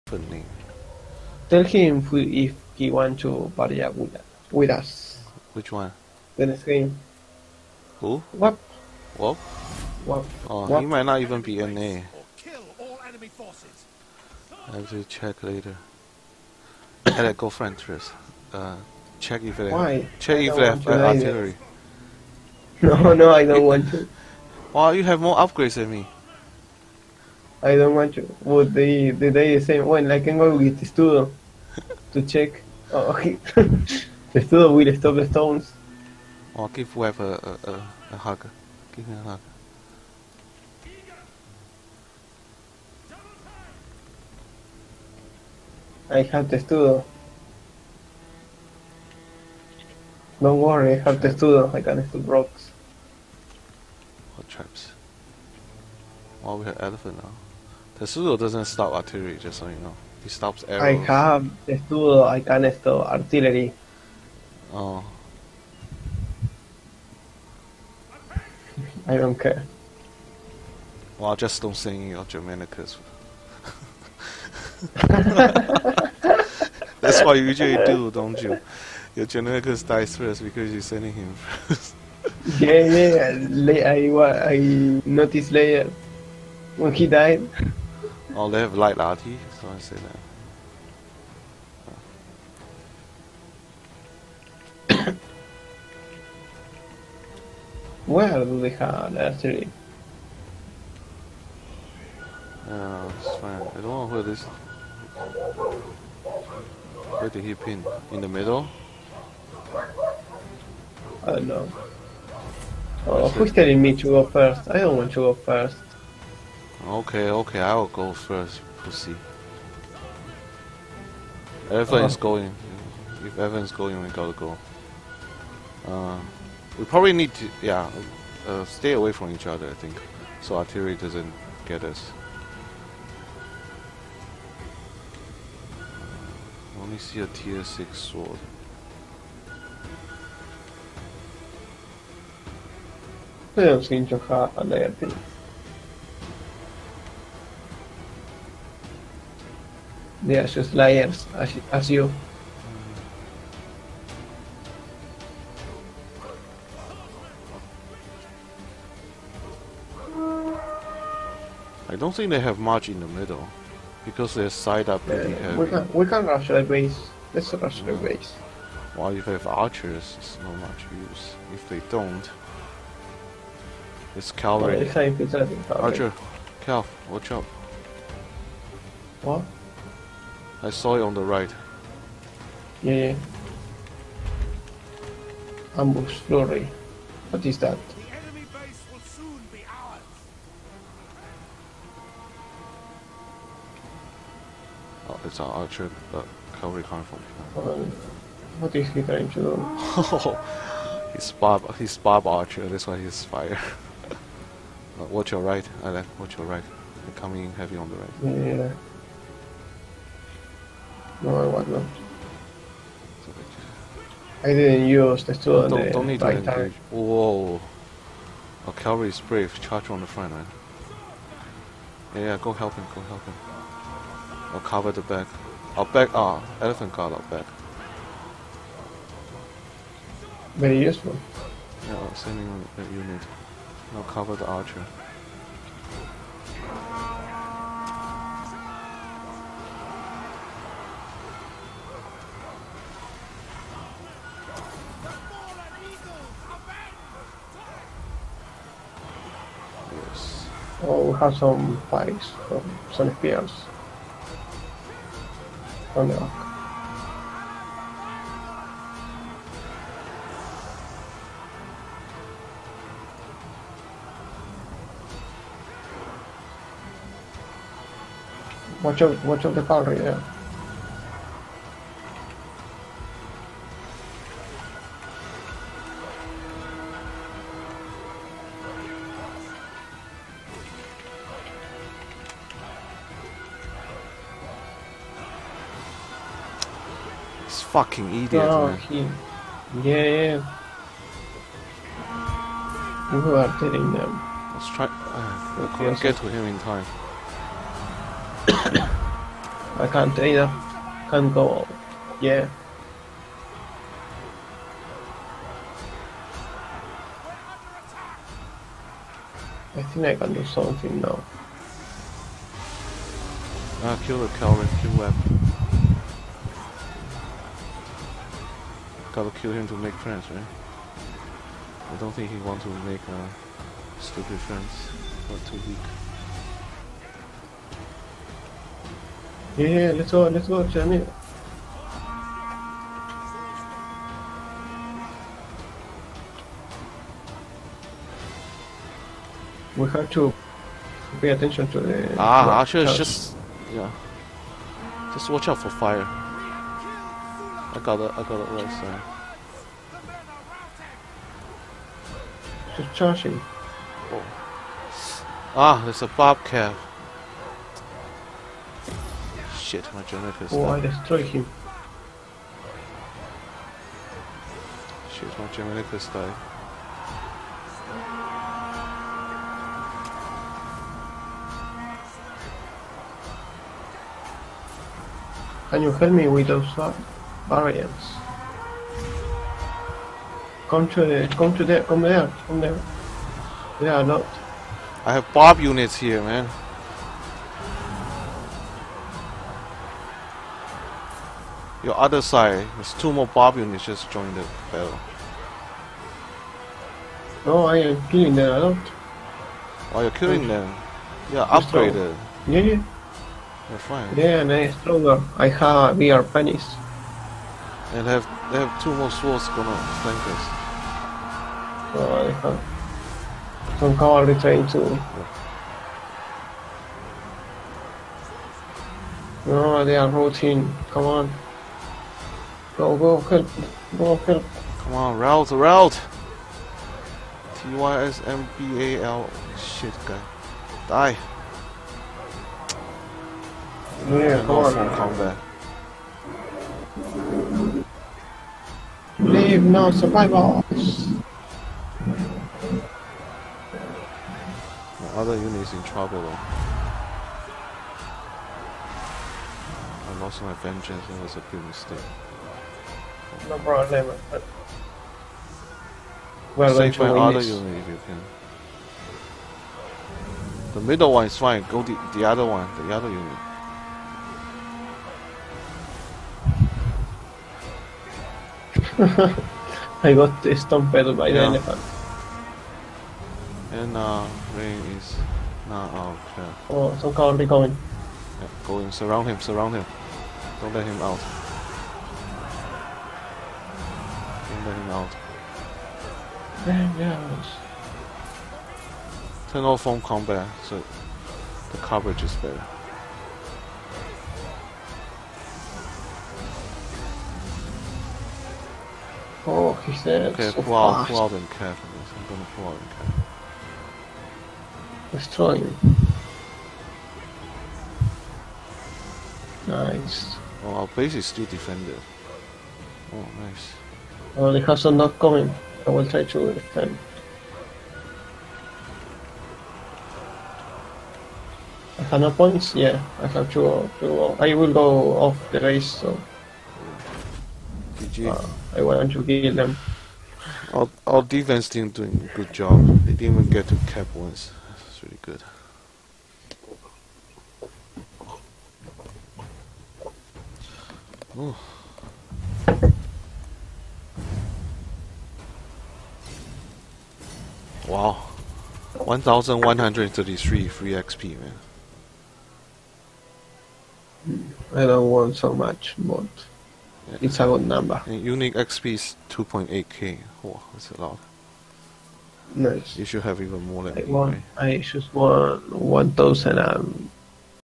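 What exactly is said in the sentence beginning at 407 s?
And have they have two more swords gonna flank us.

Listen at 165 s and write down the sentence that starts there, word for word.
We can, we can rush their base.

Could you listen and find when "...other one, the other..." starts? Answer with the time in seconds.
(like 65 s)
462 s.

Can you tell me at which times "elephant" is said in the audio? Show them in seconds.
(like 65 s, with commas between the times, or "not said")
56 s, 226 s, 471 s.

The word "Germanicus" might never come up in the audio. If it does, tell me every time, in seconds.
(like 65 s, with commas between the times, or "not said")
72 s, 79 s.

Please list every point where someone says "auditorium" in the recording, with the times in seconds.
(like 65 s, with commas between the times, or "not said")
not said.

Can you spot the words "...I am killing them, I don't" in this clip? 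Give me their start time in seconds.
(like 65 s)
397 s.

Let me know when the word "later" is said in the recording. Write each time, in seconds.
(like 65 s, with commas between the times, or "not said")
15 s, 85 s.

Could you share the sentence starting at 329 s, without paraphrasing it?
Yeah, yeah, let's go, let's go, Chani.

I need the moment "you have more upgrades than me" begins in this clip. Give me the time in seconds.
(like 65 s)
24 s.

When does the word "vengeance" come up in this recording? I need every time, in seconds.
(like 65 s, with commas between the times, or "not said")
450 s.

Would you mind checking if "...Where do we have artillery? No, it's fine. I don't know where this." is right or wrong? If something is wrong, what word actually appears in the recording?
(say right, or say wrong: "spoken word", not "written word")
right.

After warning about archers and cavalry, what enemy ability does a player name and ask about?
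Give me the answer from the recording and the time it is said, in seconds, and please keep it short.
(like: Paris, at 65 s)
Ambush flurry, at 185 s.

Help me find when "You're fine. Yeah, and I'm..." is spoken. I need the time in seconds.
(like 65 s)
403 s.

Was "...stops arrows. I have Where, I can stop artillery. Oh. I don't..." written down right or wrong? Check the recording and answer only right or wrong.
wrong.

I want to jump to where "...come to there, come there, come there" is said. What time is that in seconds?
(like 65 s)
381 s.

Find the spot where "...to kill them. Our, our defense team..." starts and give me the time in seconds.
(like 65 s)
529 s.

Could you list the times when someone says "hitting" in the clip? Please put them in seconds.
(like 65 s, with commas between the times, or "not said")
293 s.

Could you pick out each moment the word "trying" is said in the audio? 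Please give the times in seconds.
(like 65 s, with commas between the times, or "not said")
199 s.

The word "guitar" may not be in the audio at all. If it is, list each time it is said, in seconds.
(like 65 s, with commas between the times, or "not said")
not said.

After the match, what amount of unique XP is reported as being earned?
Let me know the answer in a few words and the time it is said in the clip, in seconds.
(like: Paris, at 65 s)
2.8k, at 559 s.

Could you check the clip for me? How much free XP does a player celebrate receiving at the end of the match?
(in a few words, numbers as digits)
1133.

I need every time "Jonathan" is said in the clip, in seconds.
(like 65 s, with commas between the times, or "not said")
360 s.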